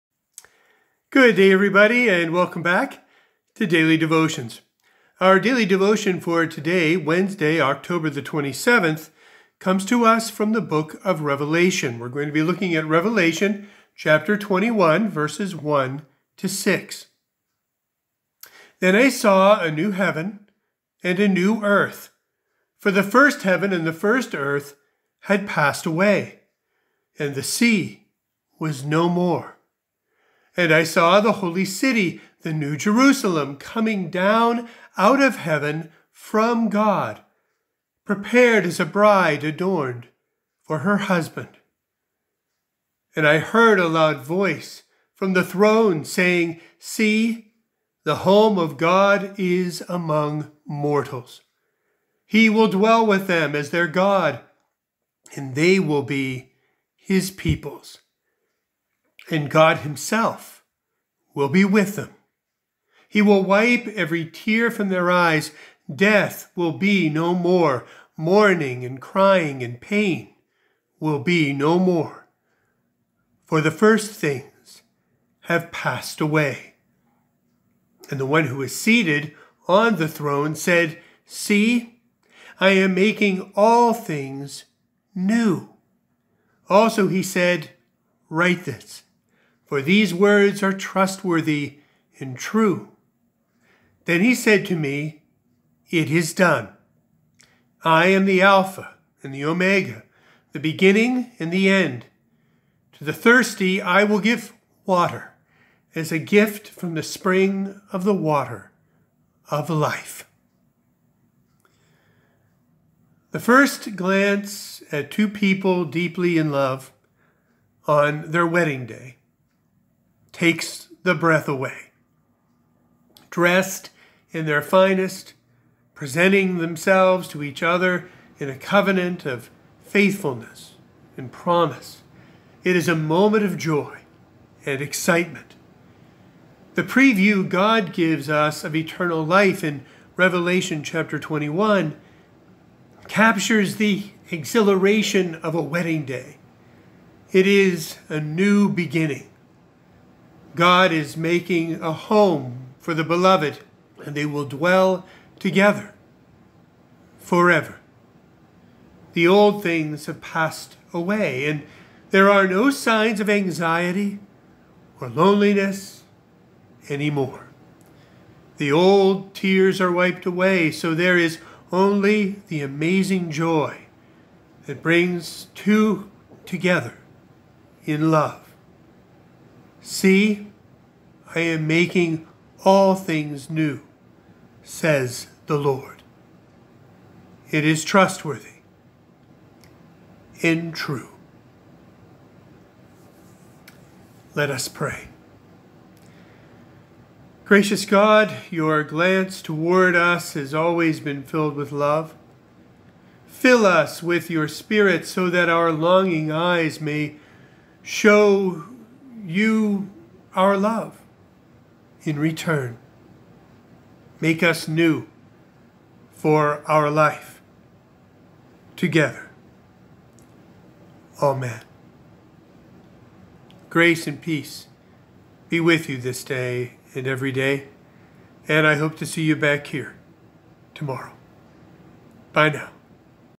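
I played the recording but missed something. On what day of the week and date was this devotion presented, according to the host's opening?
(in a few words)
Wednesday, October 27.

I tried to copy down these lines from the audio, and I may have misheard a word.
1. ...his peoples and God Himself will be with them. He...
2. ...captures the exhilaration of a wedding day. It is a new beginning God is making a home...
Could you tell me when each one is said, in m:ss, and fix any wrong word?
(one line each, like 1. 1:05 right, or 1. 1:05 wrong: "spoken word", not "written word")
1. 0:56 right
2. 2:23 right.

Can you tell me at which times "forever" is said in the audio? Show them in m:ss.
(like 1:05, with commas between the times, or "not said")
2:37.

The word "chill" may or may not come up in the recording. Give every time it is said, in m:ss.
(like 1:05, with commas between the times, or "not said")
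not said.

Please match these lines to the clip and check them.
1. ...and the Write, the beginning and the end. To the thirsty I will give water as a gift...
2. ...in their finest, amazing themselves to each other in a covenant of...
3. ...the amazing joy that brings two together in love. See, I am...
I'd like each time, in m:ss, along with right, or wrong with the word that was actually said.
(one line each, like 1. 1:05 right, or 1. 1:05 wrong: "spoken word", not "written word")
1. 1:39 wrong: "Omega", not "Write"
2. 2:04 wrong: "presenting", not "amazing"
3. 2:52 right.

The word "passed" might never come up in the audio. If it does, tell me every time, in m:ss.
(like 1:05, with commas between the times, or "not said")
0:25, 1:15, 2:40.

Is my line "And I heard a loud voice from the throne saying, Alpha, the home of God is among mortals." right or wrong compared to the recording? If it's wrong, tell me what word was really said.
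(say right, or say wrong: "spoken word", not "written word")
wrong: "See", not "Alpha".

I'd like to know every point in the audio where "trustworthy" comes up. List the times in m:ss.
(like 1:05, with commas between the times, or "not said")
1:30, 3:07.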